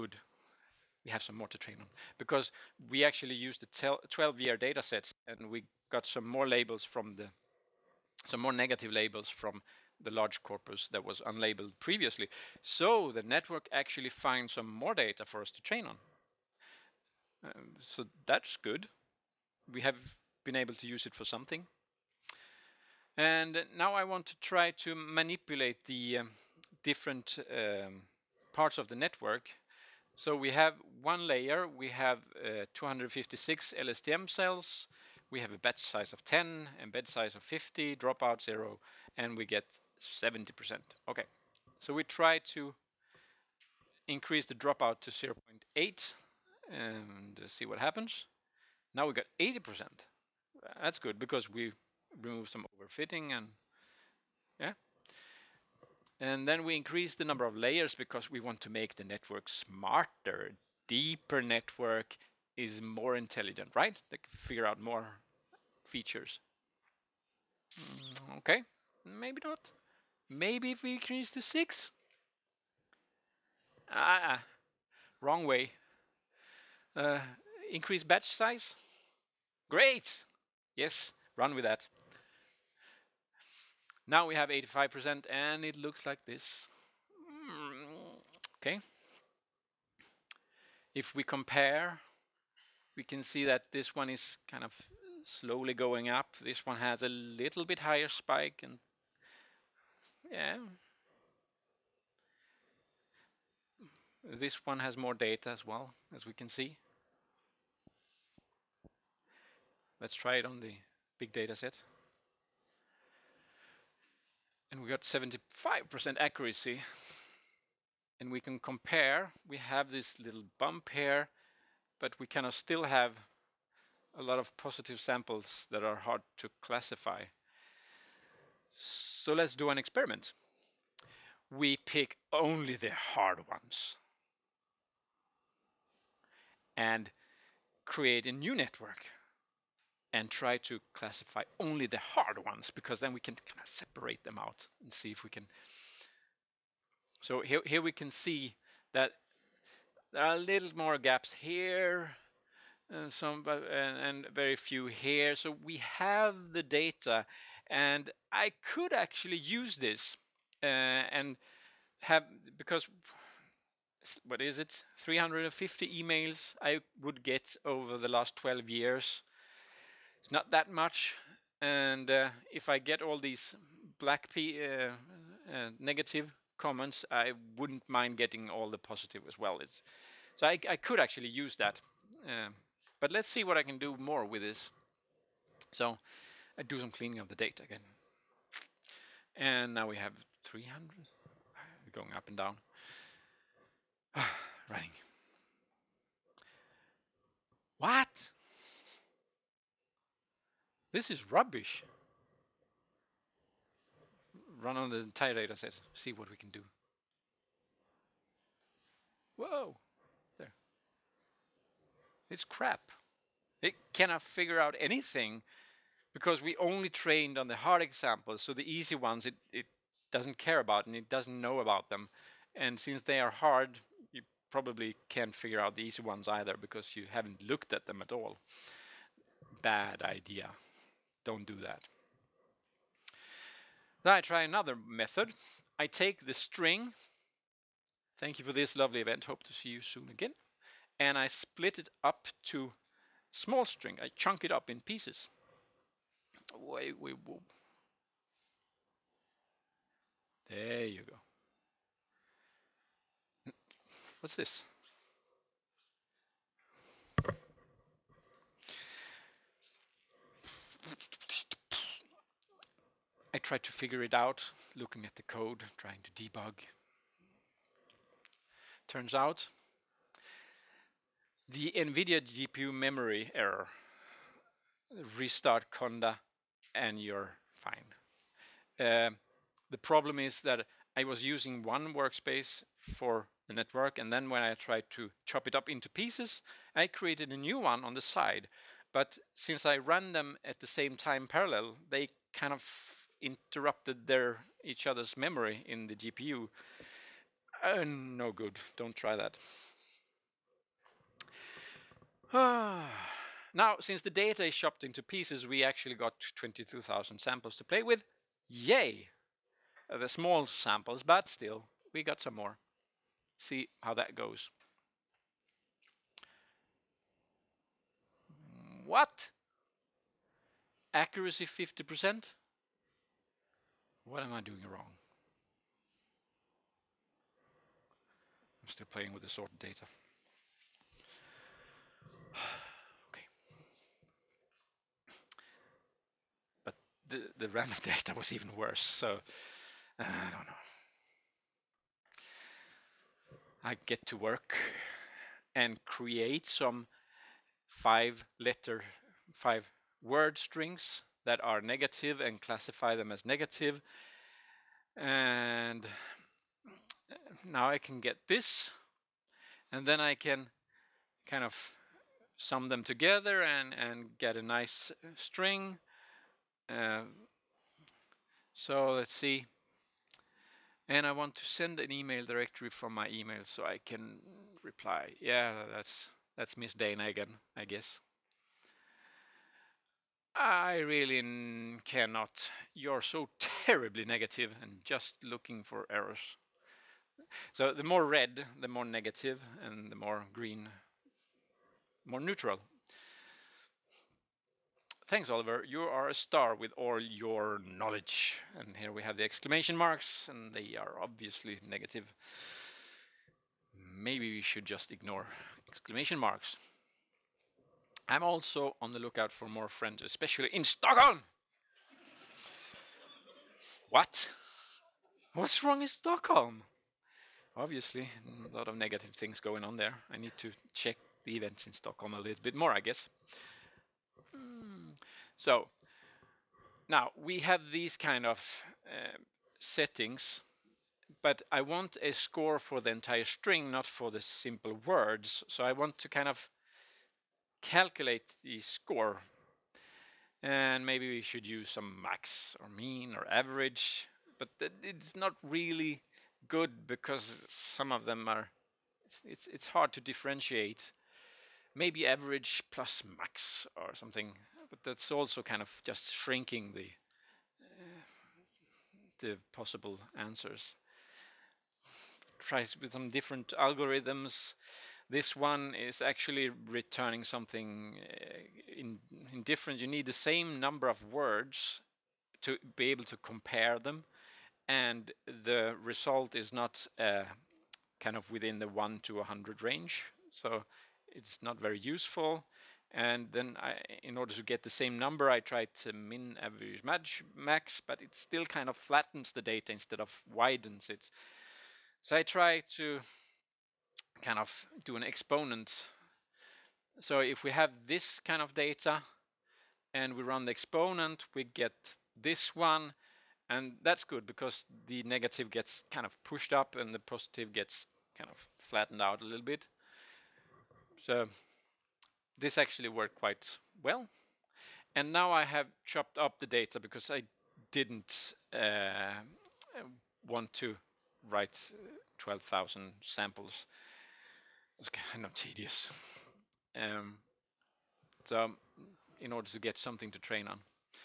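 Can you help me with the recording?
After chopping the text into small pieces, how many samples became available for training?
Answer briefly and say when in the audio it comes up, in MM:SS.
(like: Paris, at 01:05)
22,000, at 05:06.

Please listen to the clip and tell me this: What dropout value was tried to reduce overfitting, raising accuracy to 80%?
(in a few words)
0.8.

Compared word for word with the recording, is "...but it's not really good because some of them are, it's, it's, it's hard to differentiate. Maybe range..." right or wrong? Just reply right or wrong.
wrong.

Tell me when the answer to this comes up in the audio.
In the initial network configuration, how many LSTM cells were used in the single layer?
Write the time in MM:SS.
00:32.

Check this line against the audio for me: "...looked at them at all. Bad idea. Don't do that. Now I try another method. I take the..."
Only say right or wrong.
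right.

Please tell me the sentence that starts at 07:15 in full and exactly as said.
So I want to kind of calculate the score.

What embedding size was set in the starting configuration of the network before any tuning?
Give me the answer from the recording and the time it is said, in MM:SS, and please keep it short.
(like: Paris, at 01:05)
50, at 00:36.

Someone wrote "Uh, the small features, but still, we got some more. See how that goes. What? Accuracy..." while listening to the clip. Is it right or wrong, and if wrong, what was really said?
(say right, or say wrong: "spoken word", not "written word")
wrong: "samples", not "features".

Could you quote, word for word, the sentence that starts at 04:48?
But since I ran them at the same time parallel, they kind of interrupted their each other's memory in the GPU.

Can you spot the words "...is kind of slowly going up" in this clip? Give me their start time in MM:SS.
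01:34.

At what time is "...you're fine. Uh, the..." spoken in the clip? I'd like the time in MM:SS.
04:37.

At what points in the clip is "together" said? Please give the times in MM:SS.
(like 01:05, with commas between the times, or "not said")
06:02.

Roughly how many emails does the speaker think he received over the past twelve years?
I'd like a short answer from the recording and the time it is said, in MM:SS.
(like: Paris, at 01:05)
350, at 02:44.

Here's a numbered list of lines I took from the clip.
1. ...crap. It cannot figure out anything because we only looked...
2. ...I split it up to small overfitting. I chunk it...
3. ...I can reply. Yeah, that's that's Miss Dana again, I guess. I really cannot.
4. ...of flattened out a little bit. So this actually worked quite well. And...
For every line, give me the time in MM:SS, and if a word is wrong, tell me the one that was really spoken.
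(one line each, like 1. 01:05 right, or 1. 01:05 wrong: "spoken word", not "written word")
1. 03:32 wrong: "trained", not "looked"
2. 04:01 wrong: "string", not "overfitting"
3. 06:13 right
4. 08:28 right.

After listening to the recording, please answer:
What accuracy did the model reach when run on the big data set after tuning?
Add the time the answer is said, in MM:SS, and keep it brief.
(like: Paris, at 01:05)
75%, at 01:55.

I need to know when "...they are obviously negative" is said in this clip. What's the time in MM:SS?
06:40.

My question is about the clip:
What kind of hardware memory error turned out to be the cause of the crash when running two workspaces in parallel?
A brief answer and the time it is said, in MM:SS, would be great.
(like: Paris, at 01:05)
NVIDIA GPU memory error, at 04:31.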